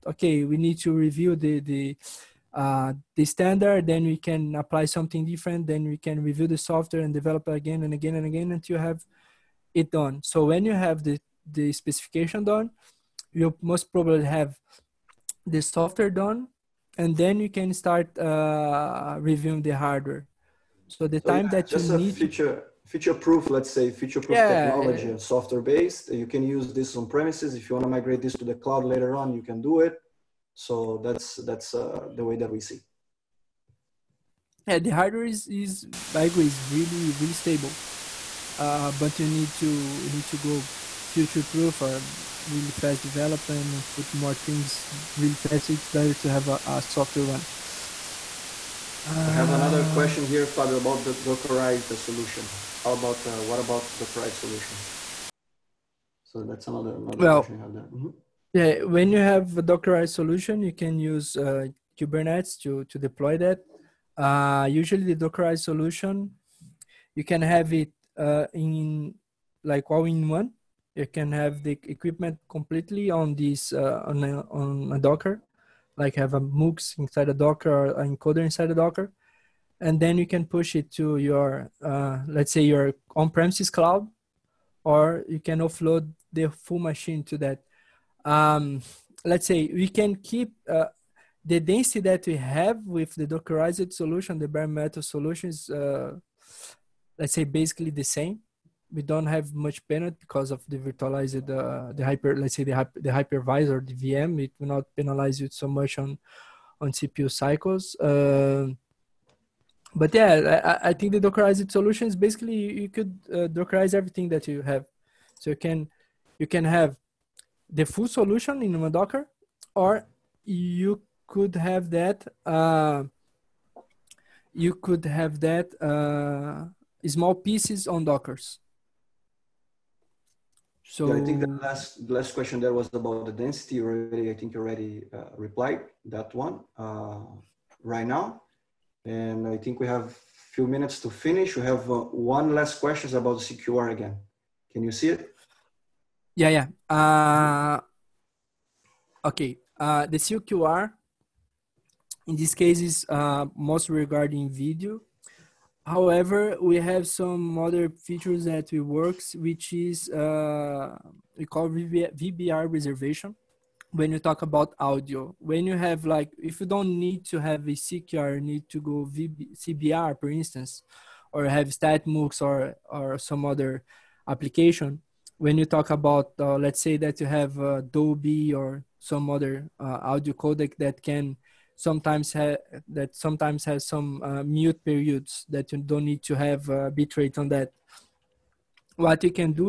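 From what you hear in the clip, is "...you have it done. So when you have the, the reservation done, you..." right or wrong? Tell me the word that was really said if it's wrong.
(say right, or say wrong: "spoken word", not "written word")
wrong: "specification", not "reservation".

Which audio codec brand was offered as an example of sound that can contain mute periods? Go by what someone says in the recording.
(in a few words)
Dolby.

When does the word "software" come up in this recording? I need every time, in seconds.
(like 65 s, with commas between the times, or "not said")
6 s, 15 s, 25 s.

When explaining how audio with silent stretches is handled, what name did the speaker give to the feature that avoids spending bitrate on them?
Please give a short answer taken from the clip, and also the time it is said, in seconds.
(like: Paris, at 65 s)
VBR reservation, at 161 s.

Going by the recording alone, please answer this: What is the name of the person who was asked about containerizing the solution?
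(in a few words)
Fabio.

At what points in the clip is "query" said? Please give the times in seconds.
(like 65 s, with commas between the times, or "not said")
not said.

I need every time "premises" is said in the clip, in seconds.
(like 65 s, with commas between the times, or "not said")
27 s, 83 s.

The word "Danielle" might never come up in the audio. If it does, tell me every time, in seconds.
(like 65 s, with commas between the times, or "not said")
not said.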